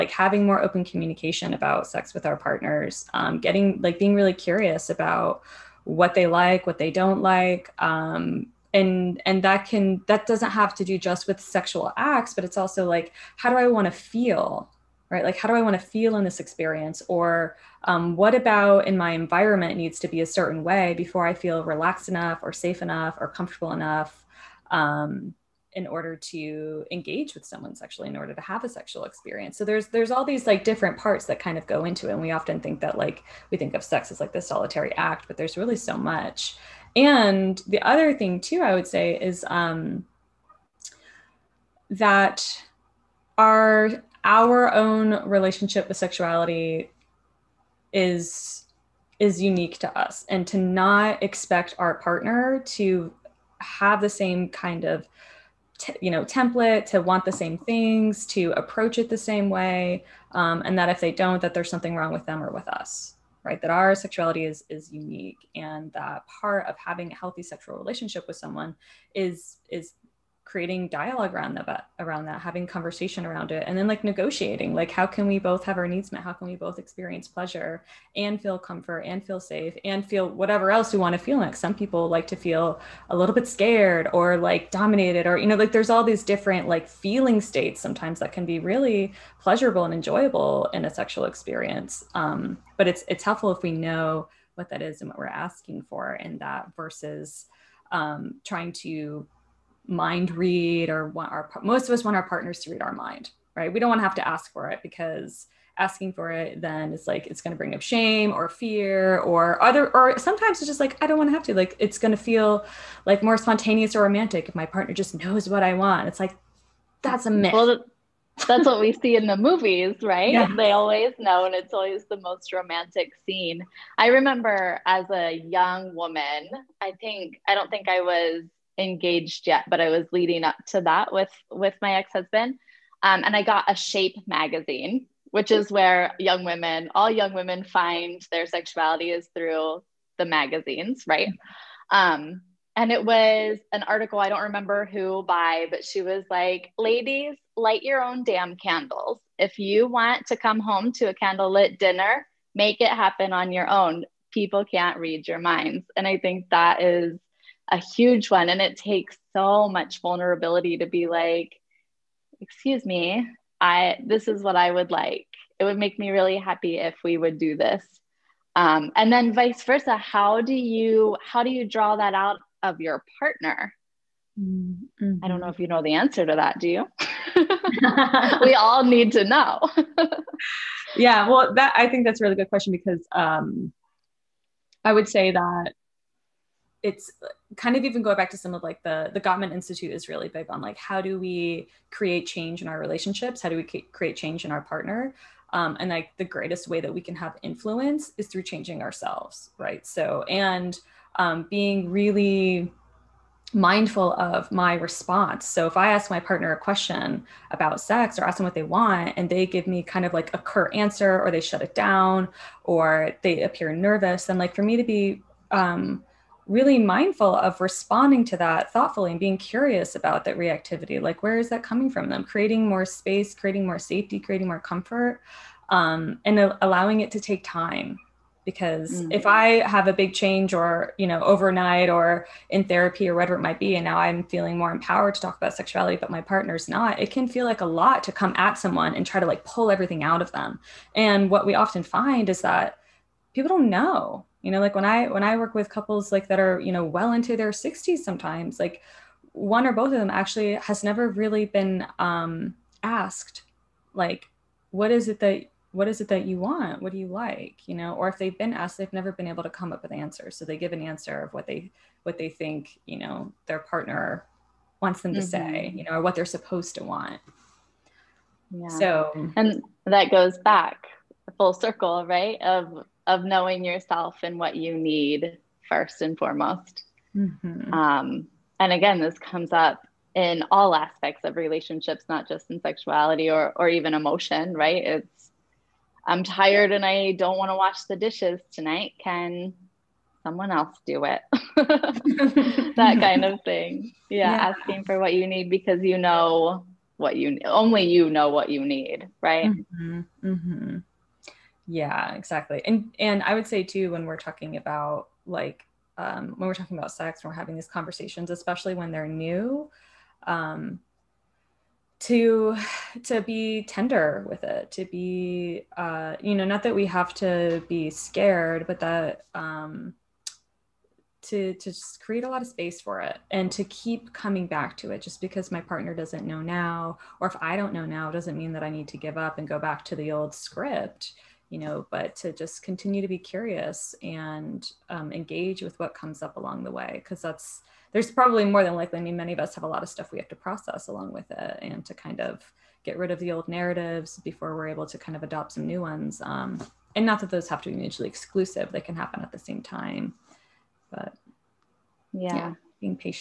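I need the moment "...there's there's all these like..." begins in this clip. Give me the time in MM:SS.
00:29.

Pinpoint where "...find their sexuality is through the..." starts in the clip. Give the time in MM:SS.
02:17.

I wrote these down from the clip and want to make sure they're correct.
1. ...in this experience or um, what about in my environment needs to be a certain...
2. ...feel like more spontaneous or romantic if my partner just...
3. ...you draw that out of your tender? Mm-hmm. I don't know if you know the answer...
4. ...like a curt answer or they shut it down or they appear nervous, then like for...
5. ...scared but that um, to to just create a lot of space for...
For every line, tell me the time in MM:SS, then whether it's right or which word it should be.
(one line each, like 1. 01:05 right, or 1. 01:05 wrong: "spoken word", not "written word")
1. 00:16 right
2. 01:52 right
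3. 02:51 wrong: "partner", not "tender"
4. 03:30 right
5. 05:17 right.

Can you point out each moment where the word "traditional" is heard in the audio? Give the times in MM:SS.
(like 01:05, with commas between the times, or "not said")
not said.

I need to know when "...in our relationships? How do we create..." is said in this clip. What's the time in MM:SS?
03:12.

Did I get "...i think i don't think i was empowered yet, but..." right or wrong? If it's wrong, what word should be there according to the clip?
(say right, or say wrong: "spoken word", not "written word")
wrong: "engaged", not "empowered".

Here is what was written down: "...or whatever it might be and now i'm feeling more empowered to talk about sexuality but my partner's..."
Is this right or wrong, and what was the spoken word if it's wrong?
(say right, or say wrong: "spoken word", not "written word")
right.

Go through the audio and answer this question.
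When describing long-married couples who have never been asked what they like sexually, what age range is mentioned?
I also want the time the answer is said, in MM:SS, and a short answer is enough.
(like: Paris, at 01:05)
Their 60s, at 04:07.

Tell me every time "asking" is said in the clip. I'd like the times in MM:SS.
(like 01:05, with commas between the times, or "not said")
01:35, 01:45, 04:54.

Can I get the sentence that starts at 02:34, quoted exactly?
People can't read your minds." And I think that is a huge one.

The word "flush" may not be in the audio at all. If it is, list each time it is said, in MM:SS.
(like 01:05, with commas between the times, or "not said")
not said.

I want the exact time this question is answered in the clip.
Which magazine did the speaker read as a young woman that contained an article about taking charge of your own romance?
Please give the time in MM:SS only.
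02:13.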